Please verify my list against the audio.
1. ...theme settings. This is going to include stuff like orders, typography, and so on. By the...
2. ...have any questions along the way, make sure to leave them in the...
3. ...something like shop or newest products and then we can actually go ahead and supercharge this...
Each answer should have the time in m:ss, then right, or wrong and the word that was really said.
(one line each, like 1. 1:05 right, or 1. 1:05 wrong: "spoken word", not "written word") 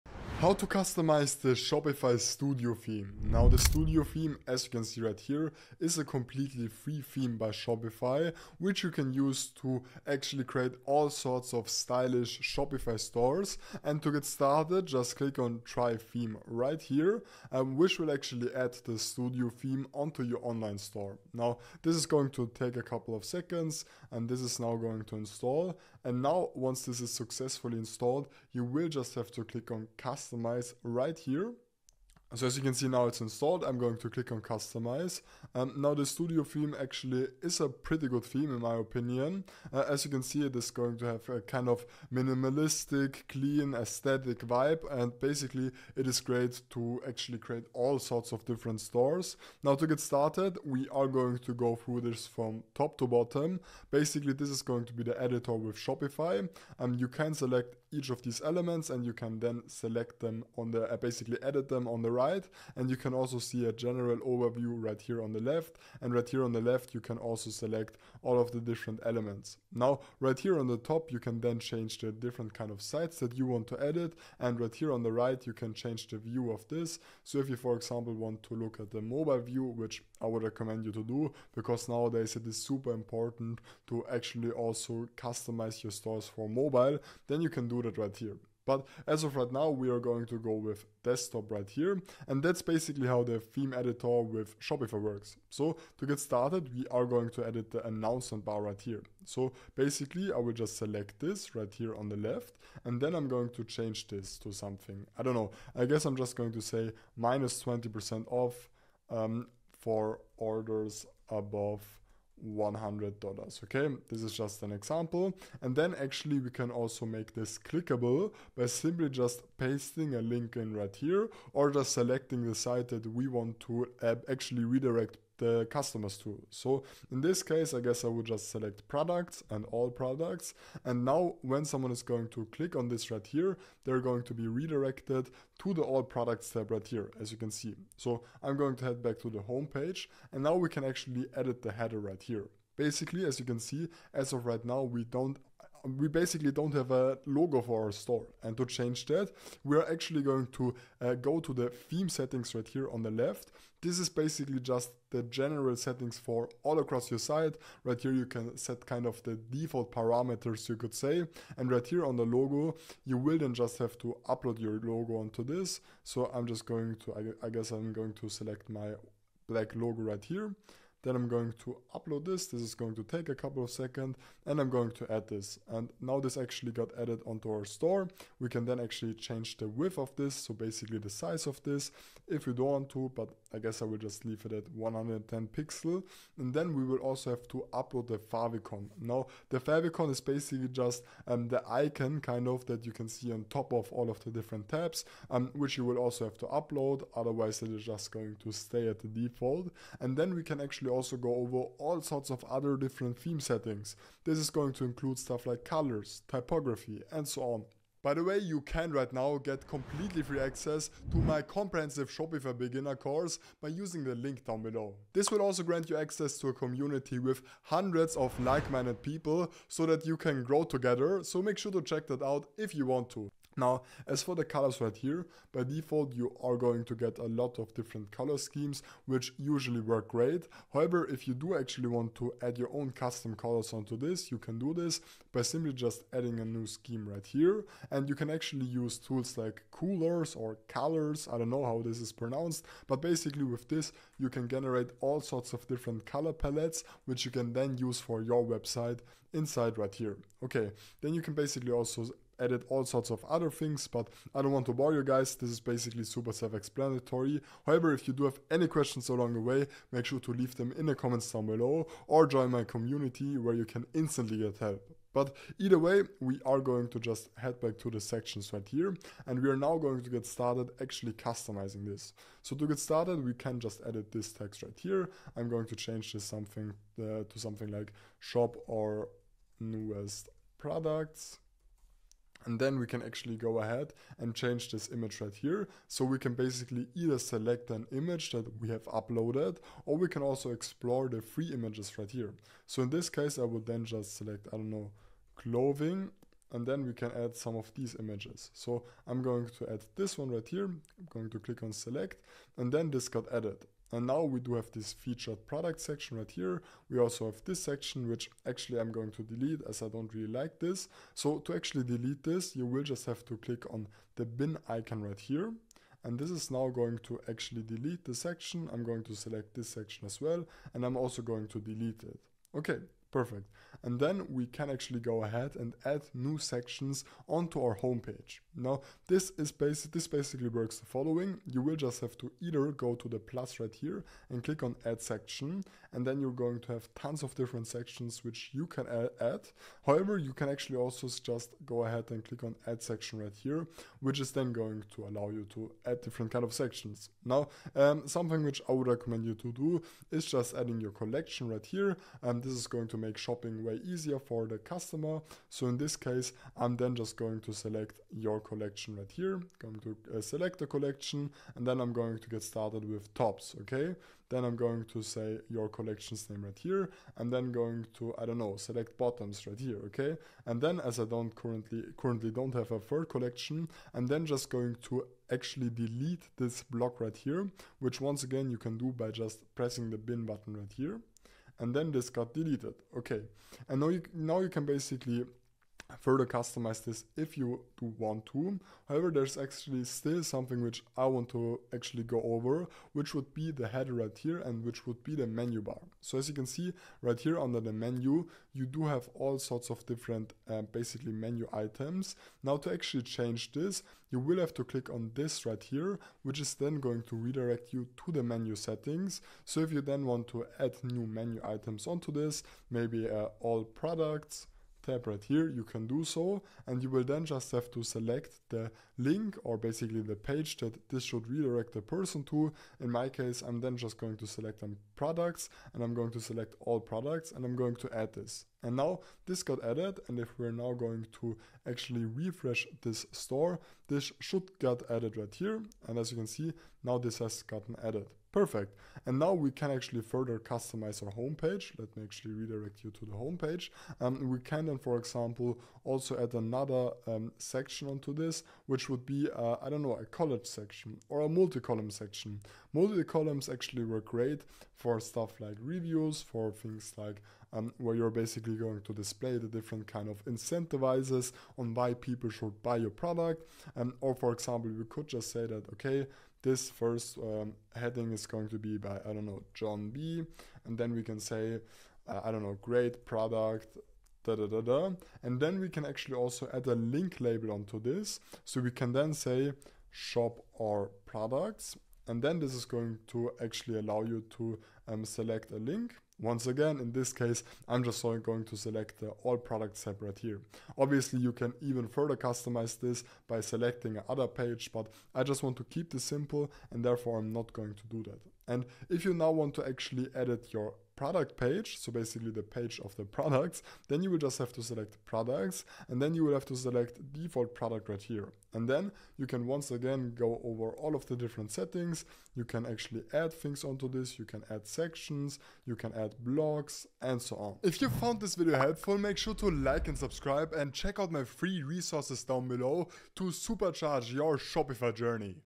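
1. 3:23 wrong: "colors", not "orders"
2. 4:18 right
3. 4:37 wrong: "change", not "supercharge".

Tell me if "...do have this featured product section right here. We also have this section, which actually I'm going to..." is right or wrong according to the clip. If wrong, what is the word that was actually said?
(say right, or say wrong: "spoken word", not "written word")
right.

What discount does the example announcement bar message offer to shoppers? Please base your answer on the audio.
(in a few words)
20% off.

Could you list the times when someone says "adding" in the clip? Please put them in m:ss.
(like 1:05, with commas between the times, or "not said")
3:56, 5:50.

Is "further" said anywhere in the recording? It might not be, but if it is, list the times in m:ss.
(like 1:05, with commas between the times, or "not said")
6:25, 7:20, 8:11.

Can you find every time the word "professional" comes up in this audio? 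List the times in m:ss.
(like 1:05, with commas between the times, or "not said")
not said.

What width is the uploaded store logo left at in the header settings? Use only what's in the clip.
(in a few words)
110 pixels.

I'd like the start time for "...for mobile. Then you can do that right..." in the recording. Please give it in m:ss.
1:26.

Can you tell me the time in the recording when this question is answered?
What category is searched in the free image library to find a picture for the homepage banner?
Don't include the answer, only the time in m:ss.
4:55.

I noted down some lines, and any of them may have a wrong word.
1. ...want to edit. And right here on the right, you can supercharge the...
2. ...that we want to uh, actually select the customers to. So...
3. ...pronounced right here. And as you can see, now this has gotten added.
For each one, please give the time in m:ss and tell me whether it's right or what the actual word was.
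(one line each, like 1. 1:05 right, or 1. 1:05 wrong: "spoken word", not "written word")
1. 1:13 wrong: "change", not "supercharge"
2. 2:02 wrong: "redirect", not "select"
3. 7:14 wrong: "added", not "pronounced".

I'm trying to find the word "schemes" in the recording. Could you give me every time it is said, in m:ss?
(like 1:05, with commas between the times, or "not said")
3:48, 3:56.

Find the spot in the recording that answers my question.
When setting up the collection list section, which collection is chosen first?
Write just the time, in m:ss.
6:03.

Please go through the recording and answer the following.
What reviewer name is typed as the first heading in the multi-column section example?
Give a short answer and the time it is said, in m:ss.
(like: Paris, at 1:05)
John B, at 7:49.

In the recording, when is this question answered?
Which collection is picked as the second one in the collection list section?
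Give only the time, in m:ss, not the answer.
6:08.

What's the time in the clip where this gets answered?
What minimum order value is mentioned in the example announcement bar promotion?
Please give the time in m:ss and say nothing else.
1:52.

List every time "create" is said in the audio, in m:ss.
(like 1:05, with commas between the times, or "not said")
0:10, 0:47.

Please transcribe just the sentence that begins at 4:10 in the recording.
Okay, then you can basically also added all sorts of other things, but I don't want to bore you guys.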